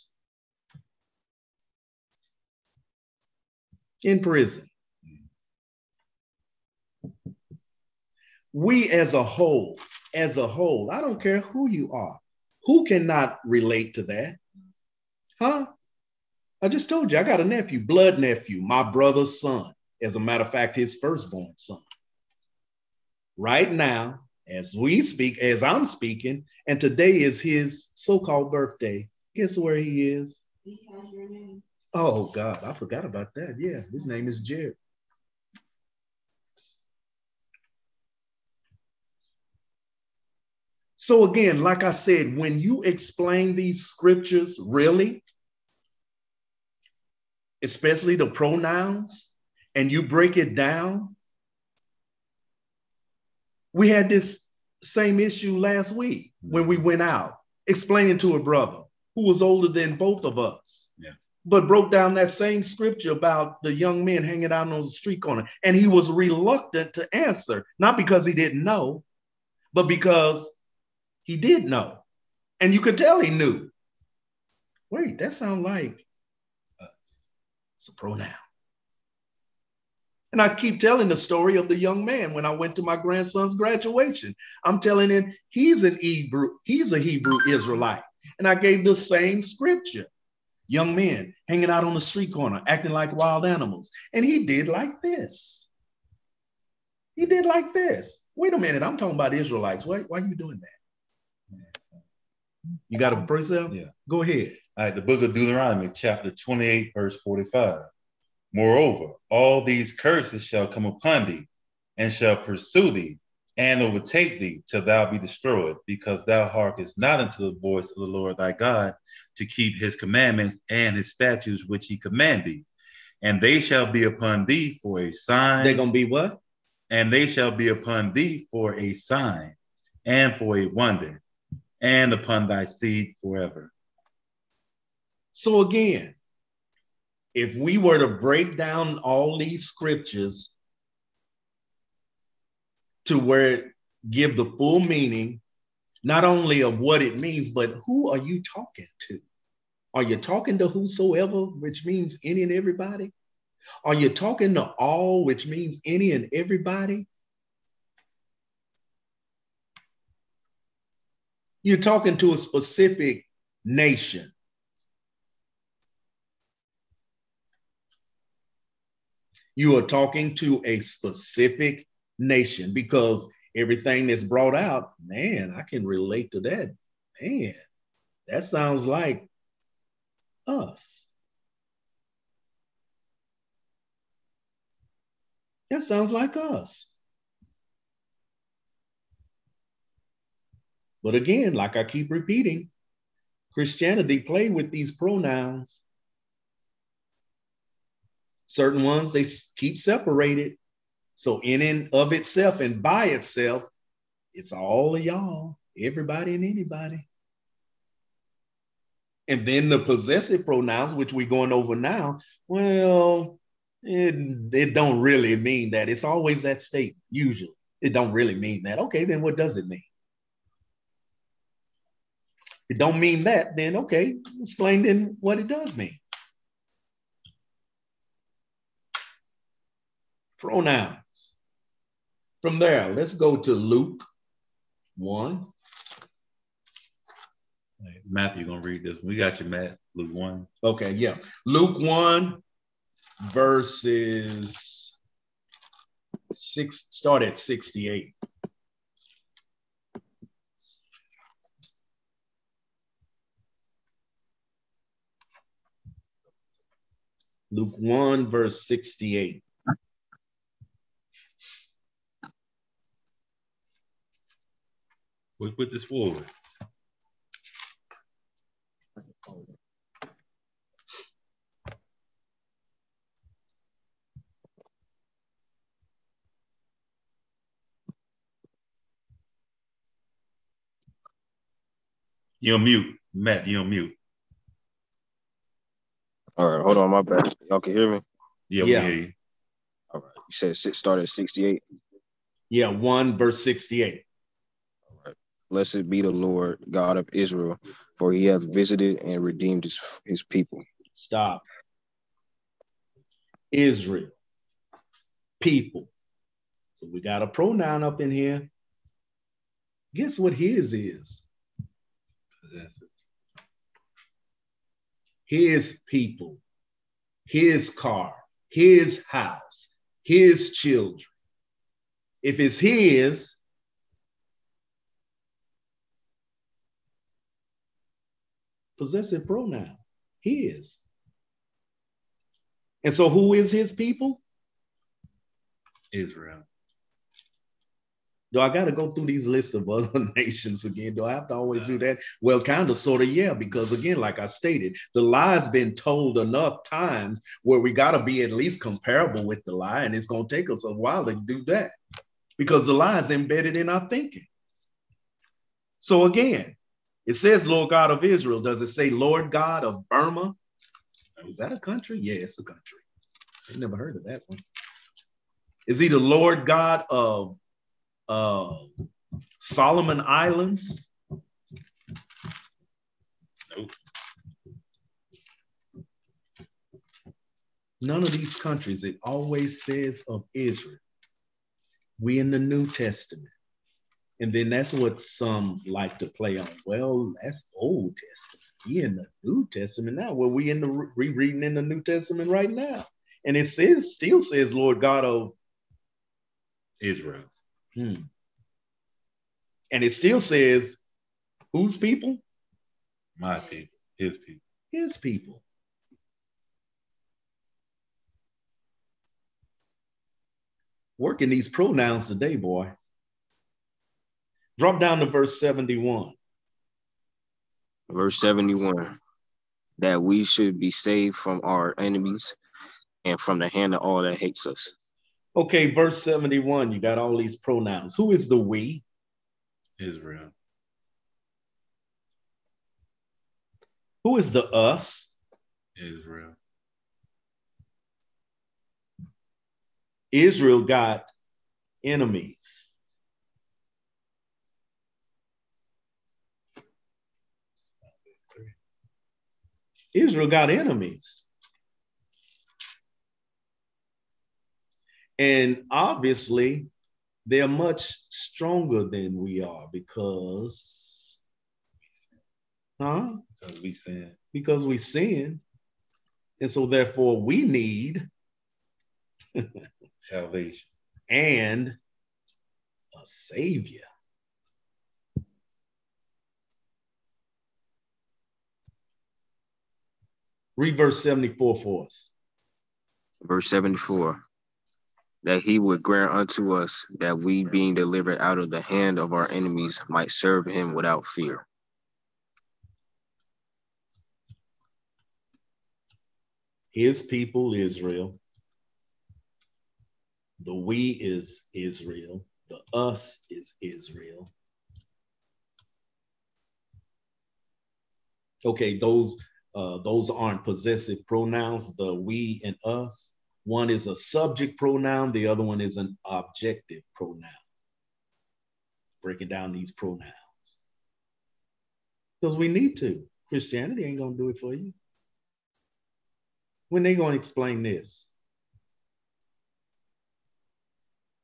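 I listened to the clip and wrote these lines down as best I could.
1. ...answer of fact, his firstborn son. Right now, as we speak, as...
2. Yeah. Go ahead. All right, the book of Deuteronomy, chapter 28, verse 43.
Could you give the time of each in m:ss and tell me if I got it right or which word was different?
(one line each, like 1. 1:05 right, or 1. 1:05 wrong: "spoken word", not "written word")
1. 0:20 wrong: "matter", not "answer"
2. 1:43 wrong: "45", not "43".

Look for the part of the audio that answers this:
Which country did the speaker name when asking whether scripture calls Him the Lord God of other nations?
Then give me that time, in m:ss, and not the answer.
5:59.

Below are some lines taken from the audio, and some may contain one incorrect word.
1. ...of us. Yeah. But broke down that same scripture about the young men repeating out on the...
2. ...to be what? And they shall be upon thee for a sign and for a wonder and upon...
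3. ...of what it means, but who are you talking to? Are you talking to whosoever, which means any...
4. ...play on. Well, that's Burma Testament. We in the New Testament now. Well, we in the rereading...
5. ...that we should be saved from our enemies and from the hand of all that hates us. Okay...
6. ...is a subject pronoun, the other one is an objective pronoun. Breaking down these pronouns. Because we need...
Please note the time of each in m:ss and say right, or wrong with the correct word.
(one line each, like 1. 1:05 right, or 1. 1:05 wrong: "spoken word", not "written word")
1. 1:00 wrong: "hanging", not "repeating"
2. 2:05 right
3. 2:26 right
4. 6:26 wrong: "Old", not "Burma"
5. 6:59 right
6. 8:33 right.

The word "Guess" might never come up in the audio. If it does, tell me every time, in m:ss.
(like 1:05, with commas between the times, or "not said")
0:29, 5:09.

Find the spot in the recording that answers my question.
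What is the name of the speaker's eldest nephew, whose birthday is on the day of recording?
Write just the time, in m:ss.
0:34.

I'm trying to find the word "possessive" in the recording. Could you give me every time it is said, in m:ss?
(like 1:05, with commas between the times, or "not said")
3:29, 5:28, 8:30.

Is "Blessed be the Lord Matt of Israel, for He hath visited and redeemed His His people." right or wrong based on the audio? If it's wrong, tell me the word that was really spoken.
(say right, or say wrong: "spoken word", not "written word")
wrong: "God", not "Matt".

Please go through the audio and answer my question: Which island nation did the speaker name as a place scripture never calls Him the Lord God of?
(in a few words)
Solomon Islands.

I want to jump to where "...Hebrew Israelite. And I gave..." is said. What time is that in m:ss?
1:26.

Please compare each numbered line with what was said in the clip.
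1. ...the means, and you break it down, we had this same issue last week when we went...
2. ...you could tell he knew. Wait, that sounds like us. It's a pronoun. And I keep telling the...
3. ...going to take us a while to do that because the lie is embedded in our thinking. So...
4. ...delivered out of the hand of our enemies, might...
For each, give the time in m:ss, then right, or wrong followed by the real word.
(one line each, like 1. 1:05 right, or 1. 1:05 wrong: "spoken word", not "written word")
1. 0:48 wrong: "pronouns", not "means"
2. 1:12 right
3. 5:50 right
4. 8:07 right.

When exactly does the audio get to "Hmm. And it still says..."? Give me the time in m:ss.
6:37.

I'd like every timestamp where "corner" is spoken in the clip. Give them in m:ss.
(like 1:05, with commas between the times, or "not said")
1:05, 1:32.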